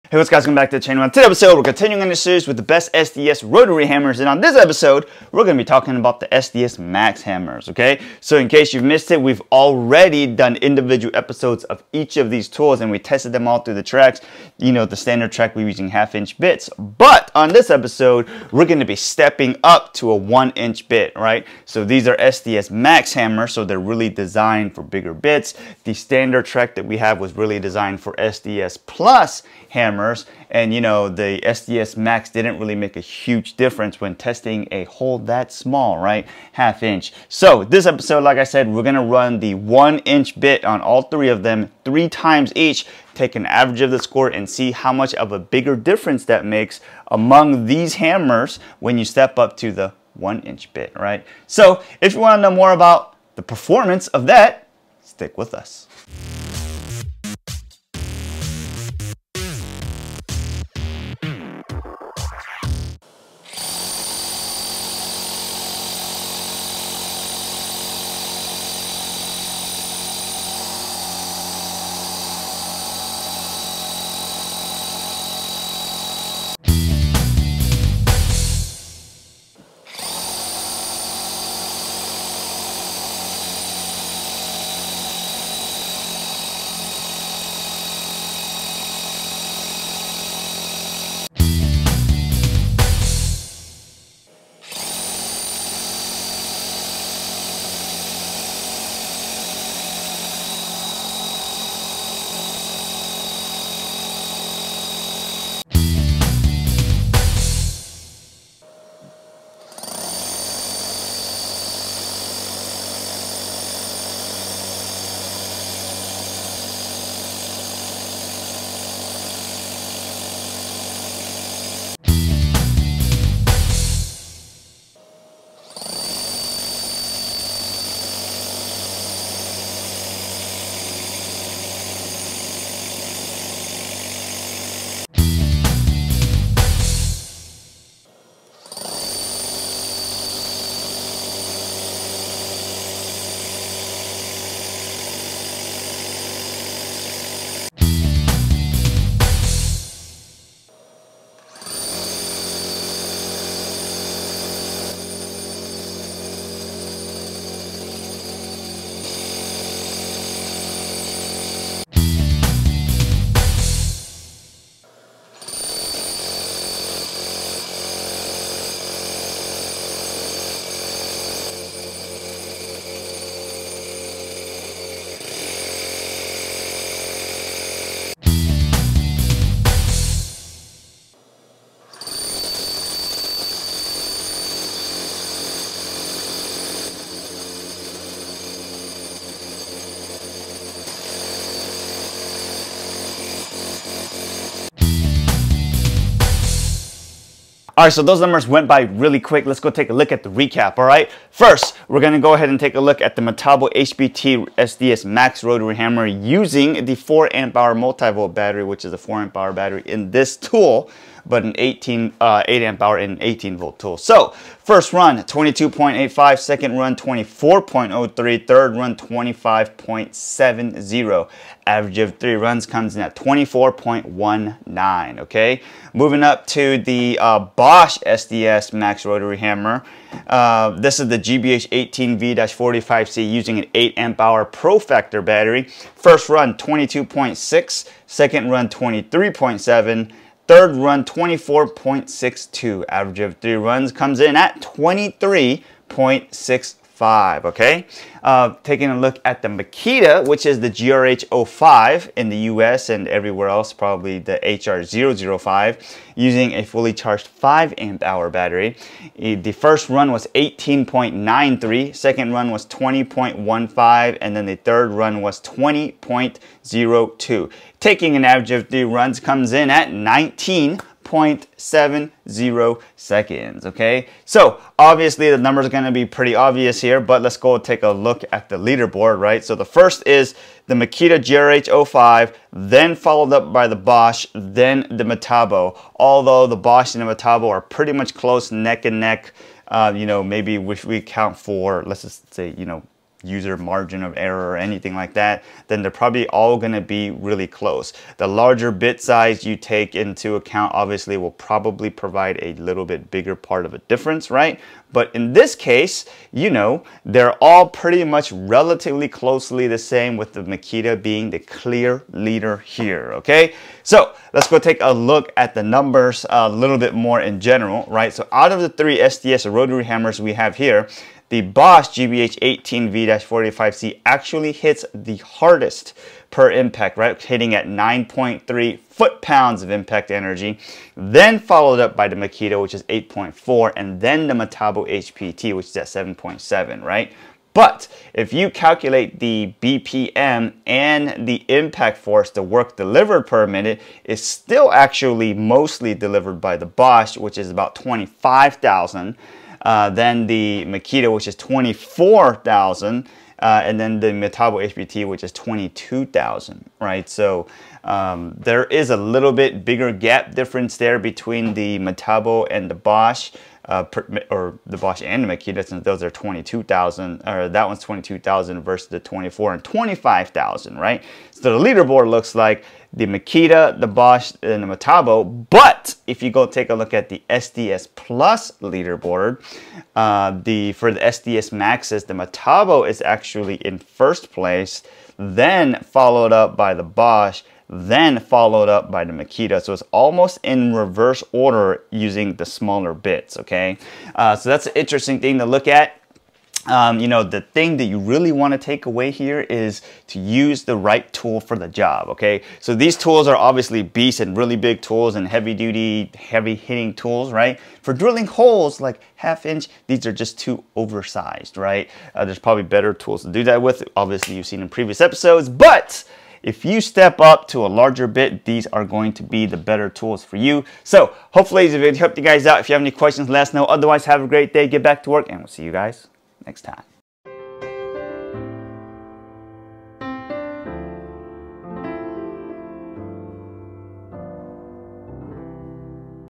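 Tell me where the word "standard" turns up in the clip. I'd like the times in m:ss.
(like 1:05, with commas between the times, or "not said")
0:14, 0:25.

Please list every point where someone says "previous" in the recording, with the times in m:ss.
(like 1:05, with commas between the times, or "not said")
6:54.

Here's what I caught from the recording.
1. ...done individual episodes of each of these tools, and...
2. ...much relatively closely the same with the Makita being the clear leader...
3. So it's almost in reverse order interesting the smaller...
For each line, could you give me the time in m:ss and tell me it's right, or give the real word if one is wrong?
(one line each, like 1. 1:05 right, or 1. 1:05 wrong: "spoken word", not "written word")
1. 0:10 right
2. 5:08 right
3. 6:29 wrong: "using", not "interesting".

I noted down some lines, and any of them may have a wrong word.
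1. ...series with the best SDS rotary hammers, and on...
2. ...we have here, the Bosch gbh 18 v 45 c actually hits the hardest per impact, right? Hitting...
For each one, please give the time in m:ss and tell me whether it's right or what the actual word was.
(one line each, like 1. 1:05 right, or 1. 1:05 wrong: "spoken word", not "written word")
1. 0:02 right
2. 5:20 right.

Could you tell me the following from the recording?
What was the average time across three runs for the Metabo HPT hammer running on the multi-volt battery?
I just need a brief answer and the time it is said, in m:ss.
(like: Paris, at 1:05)
24.19, at 3:43.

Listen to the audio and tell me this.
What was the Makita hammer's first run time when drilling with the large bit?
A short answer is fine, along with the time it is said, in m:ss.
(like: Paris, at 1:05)
18.93, at 4:20.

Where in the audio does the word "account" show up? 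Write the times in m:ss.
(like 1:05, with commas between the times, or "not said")
5:00.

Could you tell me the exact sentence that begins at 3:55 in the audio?
First run 22.6, second run 23.7, Third run, 24.62.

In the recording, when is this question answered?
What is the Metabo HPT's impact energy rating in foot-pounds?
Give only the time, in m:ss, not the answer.
5:35.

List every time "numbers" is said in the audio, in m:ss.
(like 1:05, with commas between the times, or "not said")
3:18, 4:35, 5:15.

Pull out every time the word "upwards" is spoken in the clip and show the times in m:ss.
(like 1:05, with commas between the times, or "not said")
not said.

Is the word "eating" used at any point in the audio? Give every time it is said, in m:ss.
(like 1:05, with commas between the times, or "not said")
not said.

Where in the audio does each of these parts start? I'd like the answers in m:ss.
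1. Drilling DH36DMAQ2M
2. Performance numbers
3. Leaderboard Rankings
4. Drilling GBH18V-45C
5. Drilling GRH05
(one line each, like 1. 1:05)
1. 1:03
2. 3:17
3. 4:40
4. 2:30
5. 1:48.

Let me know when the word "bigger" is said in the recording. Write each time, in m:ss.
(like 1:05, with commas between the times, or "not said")
0:24, 0:45, 5:03, 5:59.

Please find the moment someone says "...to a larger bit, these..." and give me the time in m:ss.
6:57.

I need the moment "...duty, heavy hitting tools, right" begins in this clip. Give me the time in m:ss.
6:45.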